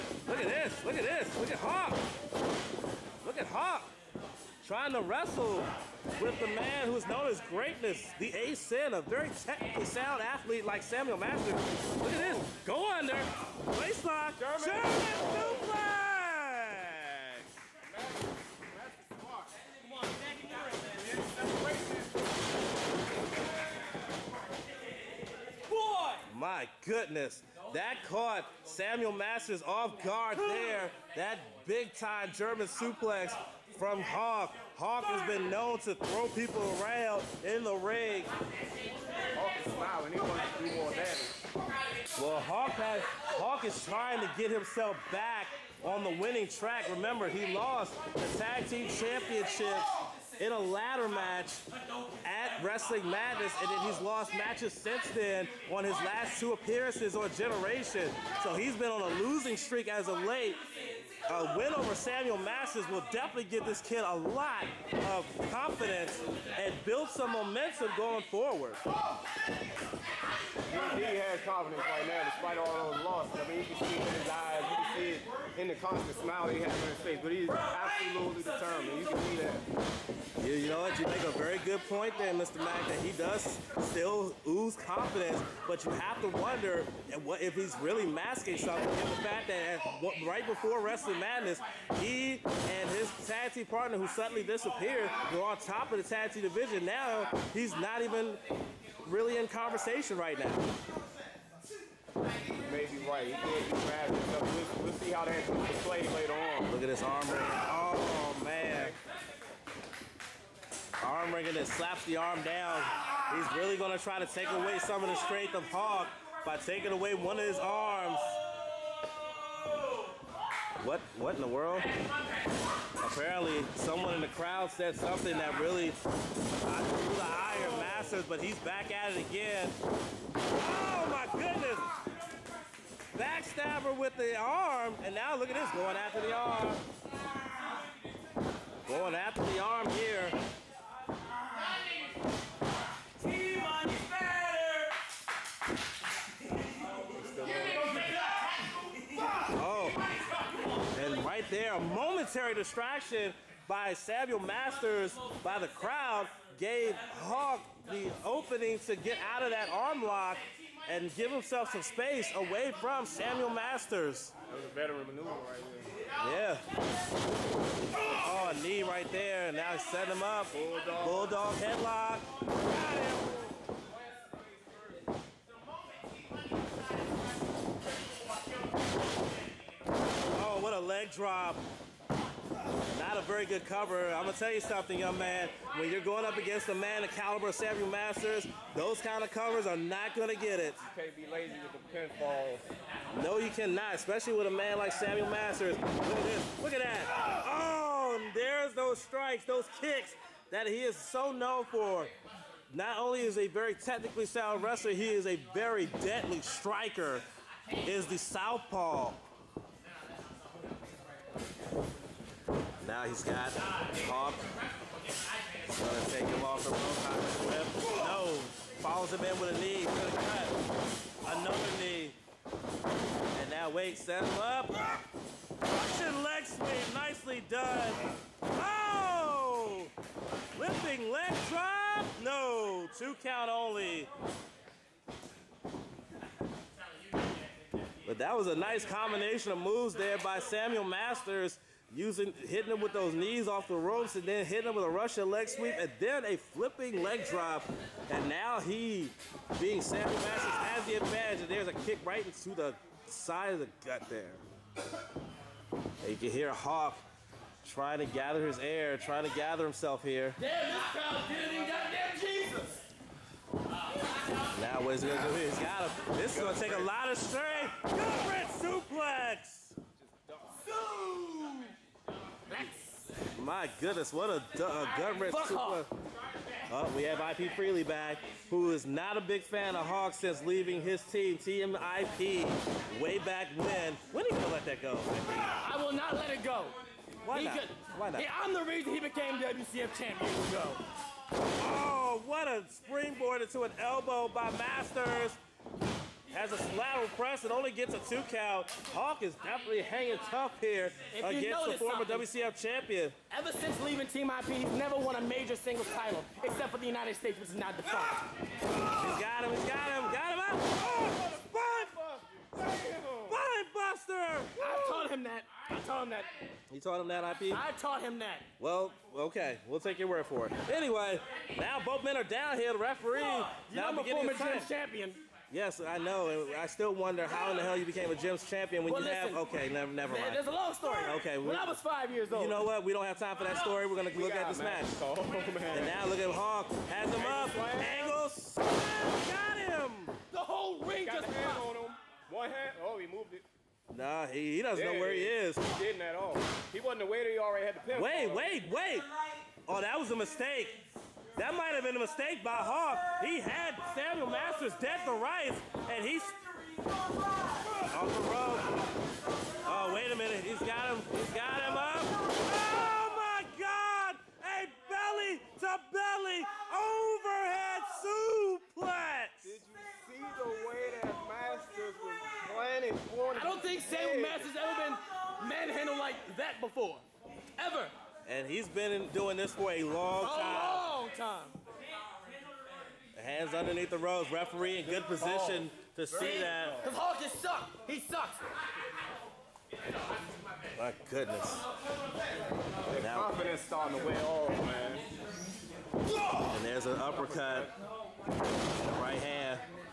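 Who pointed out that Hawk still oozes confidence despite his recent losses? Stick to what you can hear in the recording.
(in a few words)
Mr. Mack.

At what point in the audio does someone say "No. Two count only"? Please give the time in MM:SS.
03:52.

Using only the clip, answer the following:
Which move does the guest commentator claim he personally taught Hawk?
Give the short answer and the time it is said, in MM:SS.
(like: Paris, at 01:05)
Spine Buster, at 05:12.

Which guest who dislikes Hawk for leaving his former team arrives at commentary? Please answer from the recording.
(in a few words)
IP Freely.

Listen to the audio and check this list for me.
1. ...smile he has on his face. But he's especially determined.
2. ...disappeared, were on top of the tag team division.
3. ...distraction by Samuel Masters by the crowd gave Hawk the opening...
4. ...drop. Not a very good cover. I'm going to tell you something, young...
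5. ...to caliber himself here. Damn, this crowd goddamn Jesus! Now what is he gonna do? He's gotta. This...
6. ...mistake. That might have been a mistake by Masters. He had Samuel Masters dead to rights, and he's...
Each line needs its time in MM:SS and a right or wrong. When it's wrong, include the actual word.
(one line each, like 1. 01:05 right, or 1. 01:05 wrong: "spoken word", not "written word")
1. 01:16 wrong: "absolutely", not "especially"
2. 01:34 right
3. 02:32 right
4. 03:01 right
5. 04:19 wrong: "gather", not "caliber"
6. 05:50 wrong: "Hawk", not "Masters".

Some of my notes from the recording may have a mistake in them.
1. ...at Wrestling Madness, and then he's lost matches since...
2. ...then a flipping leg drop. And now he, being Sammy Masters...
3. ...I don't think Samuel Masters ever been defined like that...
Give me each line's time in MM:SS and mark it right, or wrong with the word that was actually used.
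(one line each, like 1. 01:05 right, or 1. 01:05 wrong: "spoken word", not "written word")
1. 00:52 right
2. 04:05 right
3. 06:13 wrong: "manhandled", not "defined".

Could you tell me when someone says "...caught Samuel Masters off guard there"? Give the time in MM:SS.
00:28.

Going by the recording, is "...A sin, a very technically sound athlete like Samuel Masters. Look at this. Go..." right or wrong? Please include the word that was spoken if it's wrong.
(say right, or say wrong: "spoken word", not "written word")
right.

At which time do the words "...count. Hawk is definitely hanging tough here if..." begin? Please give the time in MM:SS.
04:58.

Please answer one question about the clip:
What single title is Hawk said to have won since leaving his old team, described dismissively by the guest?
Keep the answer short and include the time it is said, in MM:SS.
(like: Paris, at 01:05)
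United States, at 05:06.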